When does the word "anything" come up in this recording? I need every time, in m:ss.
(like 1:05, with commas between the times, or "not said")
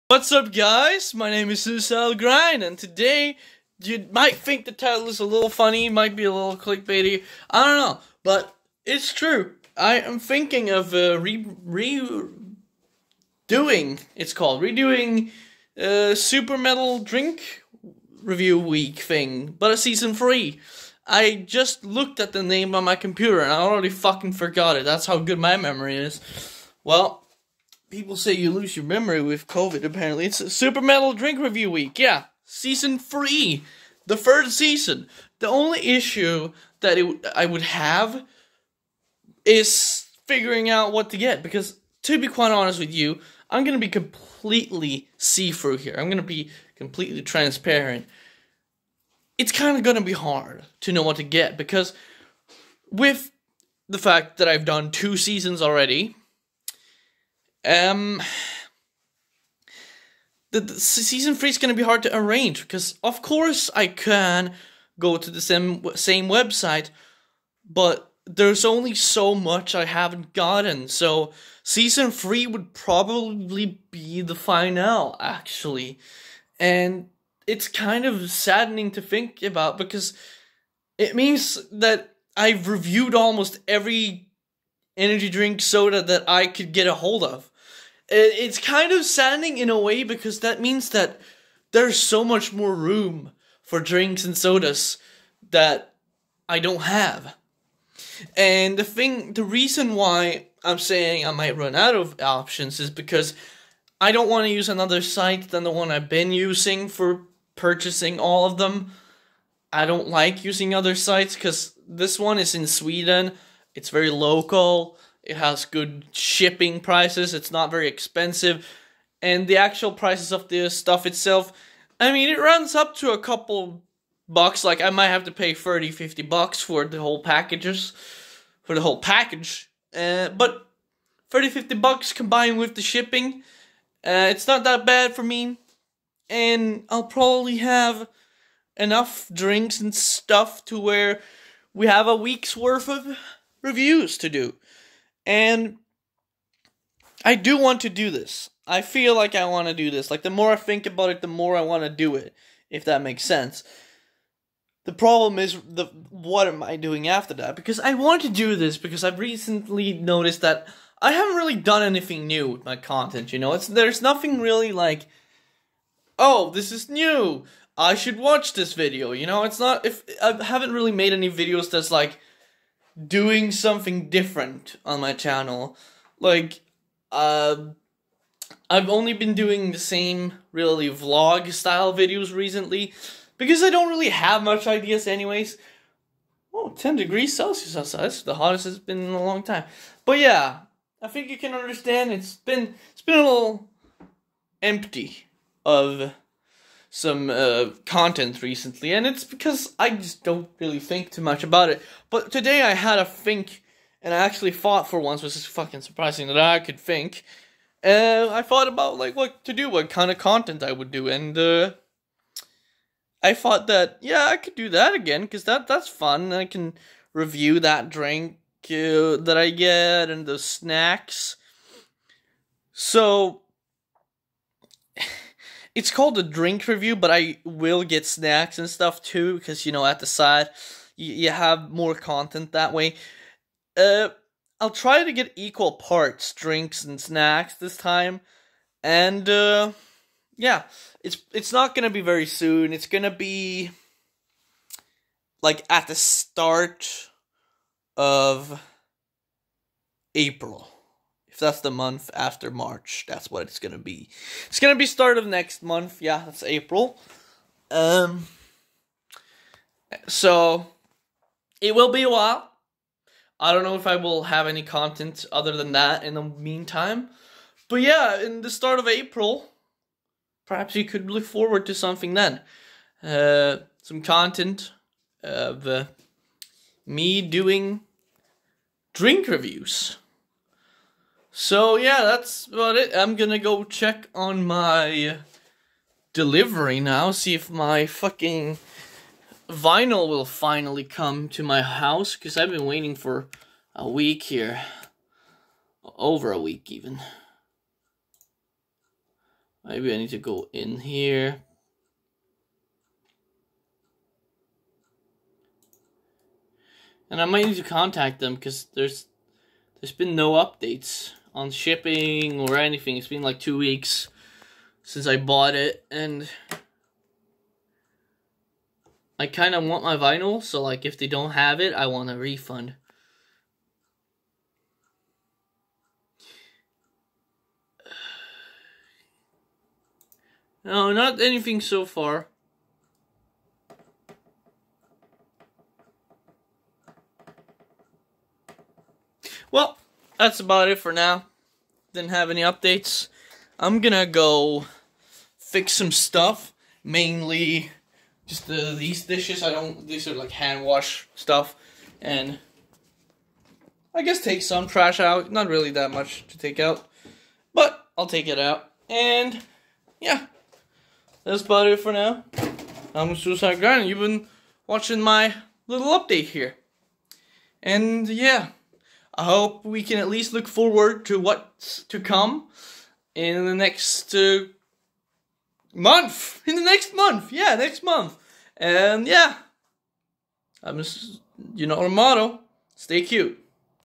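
2:41, 5:12, 5:31.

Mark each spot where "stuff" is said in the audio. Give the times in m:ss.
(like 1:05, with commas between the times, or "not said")
2:00, 2:19, 3:48, 5:45, 5:51.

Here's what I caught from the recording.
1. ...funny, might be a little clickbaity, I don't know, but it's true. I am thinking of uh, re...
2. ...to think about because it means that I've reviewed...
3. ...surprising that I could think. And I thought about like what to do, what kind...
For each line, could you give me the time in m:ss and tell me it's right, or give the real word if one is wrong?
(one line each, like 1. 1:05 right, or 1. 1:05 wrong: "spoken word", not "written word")
1. 0:05 right
2. 1:18 right
3. 3:25 right.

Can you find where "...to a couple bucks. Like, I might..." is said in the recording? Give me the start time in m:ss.
2:02.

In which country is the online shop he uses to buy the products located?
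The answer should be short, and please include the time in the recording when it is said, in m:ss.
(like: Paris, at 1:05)
Sweden, at 1:52.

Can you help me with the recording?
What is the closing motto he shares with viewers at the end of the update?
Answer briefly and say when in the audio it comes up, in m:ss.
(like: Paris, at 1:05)
stay cute, at 6:22.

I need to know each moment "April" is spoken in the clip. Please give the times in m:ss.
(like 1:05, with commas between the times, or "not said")
4:10, 4:16, 4:28.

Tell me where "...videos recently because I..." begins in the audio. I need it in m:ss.
3:01.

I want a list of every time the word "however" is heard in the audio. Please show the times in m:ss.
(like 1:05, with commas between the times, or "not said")
not said.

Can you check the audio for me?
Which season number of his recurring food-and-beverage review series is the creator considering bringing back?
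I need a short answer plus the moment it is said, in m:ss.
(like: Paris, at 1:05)
3, at 0:19.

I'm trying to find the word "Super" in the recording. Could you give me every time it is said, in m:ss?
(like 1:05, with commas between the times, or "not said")
0:16, 0:30.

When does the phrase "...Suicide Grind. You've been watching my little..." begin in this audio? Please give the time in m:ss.
6:03.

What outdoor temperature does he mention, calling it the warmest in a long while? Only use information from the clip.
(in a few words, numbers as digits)
10 degrees Celsius.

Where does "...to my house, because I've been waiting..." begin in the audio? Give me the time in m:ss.
4:51.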